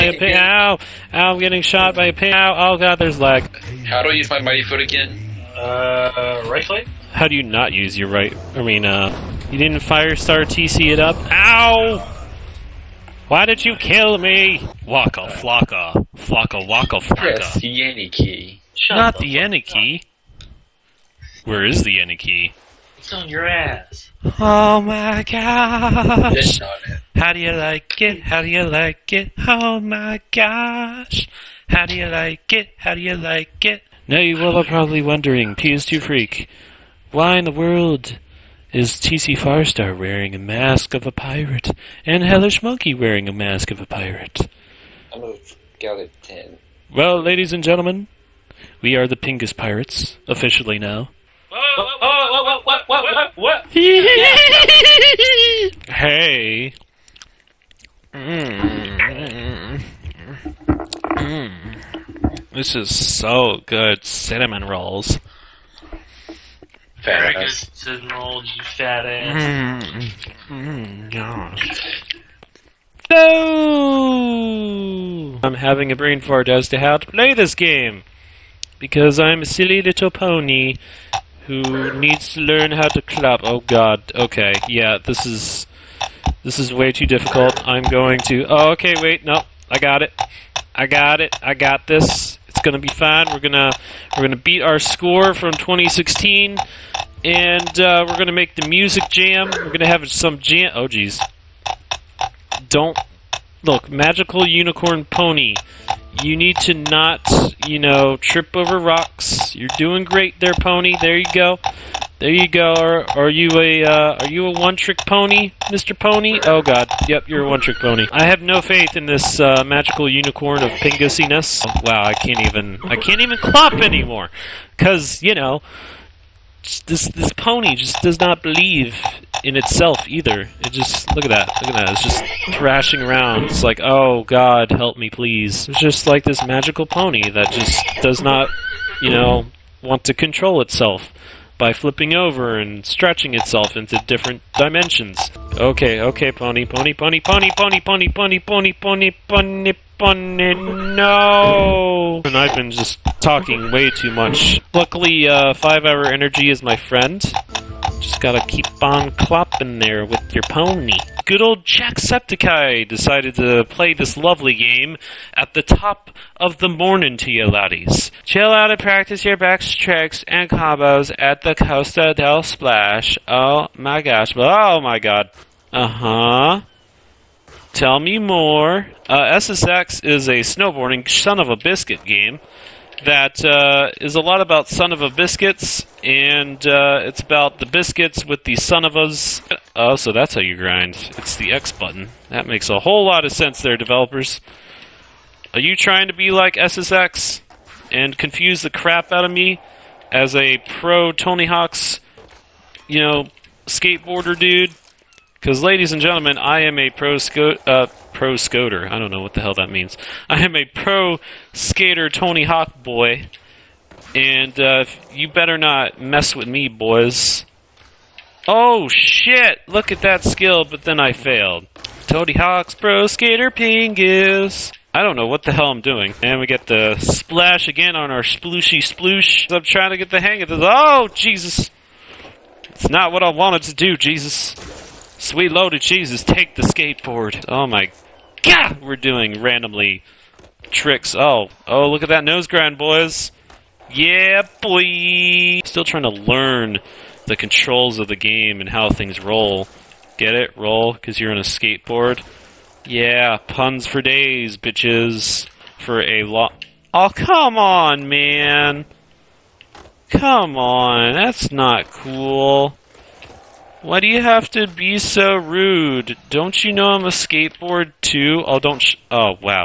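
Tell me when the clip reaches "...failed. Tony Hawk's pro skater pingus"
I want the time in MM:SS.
03:41.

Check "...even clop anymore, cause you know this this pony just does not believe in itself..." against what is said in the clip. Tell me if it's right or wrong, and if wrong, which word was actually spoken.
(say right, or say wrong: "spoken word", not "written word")
right.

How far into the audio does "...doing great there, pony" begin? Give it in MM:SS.
01:49.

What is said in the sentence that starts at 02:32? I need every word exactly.
And I've been just talking way too much.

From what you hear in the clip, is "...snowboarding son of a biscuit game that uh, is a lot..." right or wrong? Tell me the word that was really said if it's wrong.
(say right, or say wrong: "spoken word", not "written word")
right.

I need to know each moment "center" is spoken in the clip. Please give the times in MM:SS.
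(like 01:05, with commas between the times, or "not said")
not said.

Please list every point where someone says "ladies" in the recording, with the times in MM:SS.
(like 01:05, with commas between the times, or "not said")
00:47, 03:25.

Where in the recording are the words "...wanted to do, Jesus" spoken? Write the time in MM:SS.
03:53.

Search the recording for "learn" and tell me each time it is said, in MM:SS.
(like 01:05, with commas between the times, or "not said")
01:22, 04:06.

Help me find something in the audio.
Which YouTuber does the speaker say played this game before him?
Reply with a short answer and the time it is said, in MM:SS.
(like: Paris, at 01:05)
Jacksepticeye, at 02:41.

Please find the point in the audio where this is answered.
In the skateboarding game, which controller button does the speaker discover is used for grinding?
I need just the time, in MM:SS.
03:11.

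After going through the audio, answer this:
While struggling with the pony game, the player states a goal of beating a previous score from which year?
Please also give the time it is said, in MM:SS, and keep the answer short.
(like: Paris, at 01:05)
2016, at 01:35.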